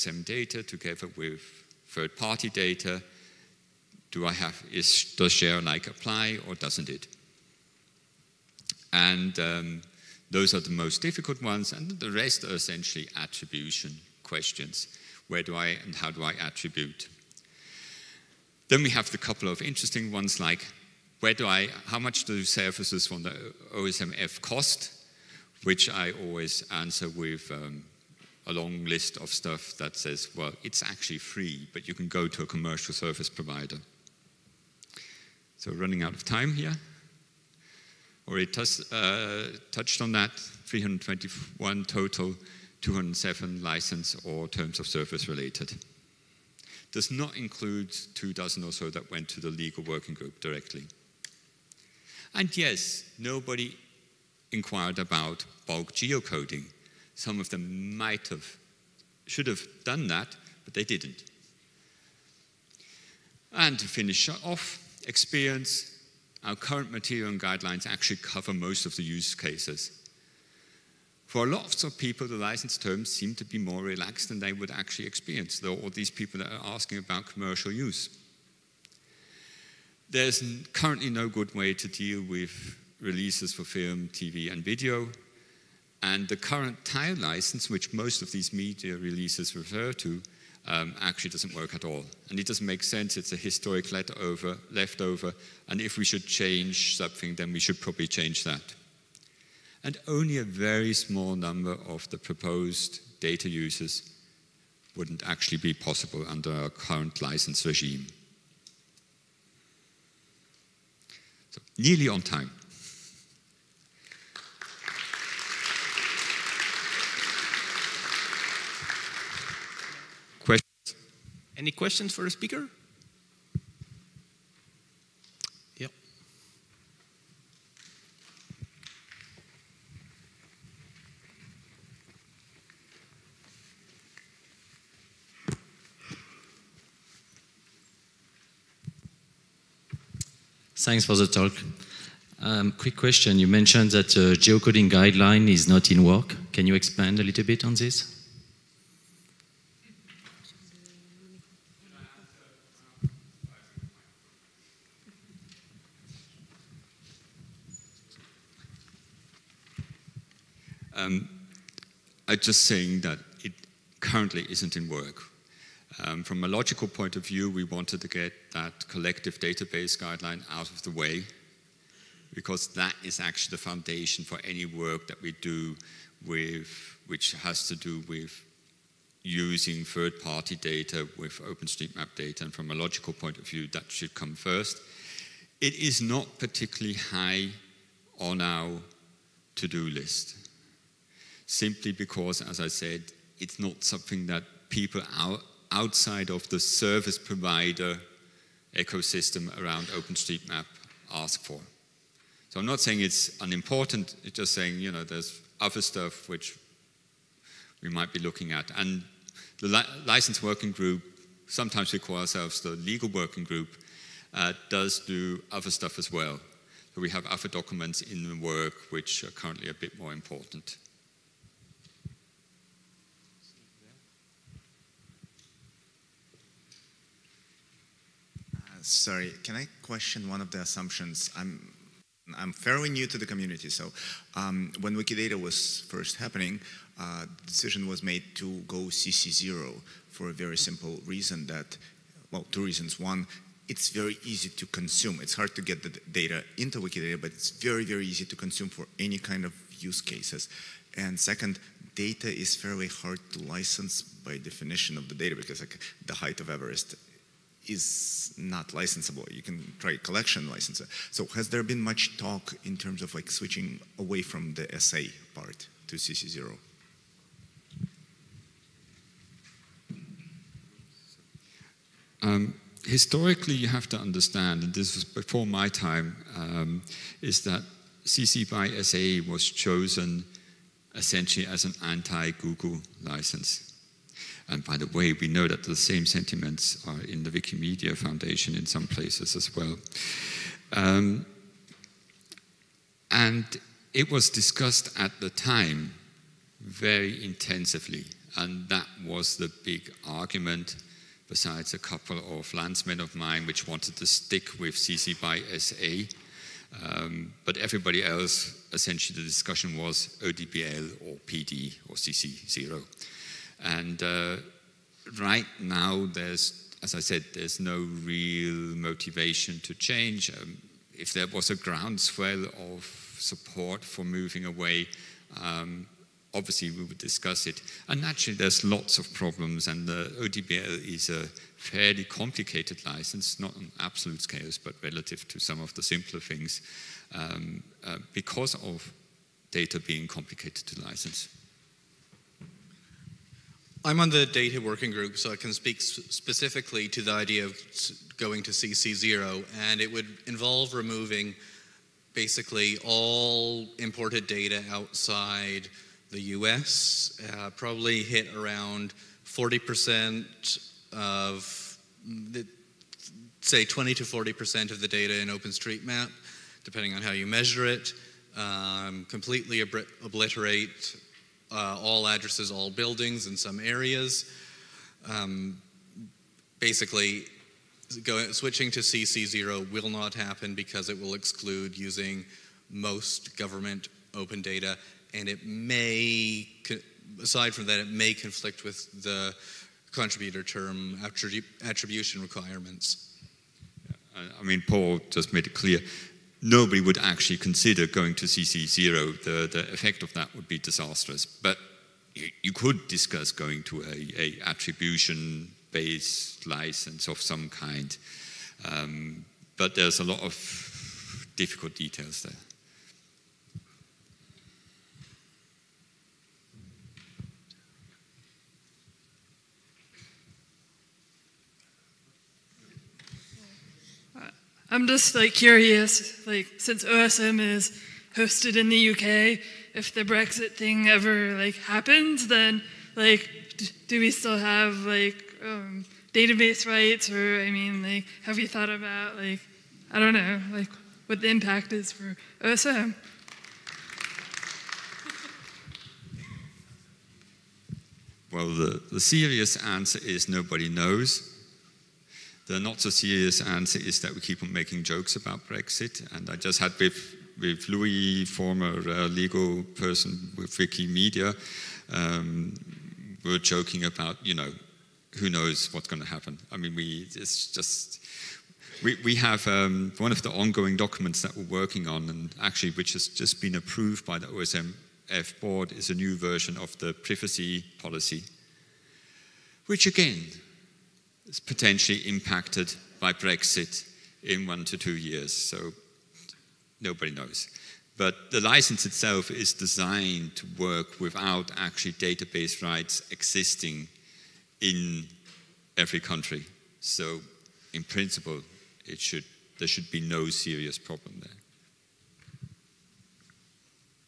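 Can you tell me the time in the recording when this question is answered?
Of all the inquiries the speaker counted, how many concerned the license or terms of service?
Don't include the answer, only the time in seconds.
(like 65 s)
42 s.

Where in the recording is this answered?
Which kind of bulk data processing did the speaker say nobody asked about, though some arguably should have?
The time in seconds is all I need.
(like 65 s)
55 s.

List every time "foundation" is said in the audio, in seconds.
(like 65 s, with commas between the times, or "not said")
173 s, 287 s.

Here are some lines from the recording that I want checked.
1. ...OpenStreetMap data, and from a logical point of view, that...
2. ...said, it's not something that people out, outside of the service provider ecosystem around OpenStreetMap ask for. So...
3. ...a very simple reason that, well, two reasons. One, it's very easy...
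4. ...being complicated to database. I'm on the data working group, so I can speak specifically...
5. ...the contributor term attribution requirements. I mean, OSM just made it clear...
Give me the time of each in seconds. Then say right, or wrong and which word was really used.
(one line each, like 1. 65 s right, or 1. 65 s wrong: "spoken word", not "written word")
1. 181 s right
2. 192 s right
3. 240 s right
4. 339 s wrong: "license", not "database"
5. 389 s wrong: "Paul", not "OSM".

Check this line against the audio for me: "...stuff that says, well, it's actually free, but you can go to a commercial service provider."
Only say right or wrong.
right.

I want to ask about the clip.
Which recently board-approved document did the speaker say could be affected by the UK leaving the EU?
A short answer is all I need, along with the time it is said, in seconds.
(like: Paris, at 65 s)
Privacy policy, at 476 s.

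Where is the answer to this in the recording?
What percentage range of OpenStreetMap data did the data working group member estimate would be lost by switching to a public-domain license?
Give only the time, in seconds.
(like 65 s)
363 s.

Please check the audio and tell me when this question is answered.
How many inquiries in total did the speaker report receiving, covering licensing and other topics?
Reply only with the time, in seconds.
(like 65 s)
40 s.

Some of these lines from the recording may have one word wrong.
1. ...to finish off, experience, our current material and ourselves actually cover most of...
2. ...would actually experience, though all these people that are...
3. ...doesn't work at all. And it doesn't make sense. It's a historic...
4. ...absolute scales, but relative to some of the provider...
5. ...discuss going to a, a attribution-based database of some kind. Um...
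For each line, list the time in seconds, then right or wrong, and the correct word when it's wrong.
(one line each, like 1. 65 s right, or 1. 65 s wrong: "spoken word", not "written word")
1. 63 s wrong: "guidelines", not "ourselves"
2. 74 s right
3. 91 s right
4. 333 s wrong: "simpler", not "provider"
5. 402 s wrong: "license", not "database".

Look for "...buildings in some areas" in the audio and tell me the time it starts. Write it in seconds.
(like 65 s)
372 s.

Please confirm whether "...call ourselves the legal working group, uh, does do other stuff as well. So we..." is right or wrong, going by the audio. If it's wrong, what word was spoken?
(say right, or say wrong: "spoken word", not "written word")
right.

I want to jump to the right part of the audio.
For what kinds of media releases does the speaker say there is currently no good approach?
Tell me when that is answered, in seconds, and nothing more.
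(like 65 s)
83 s.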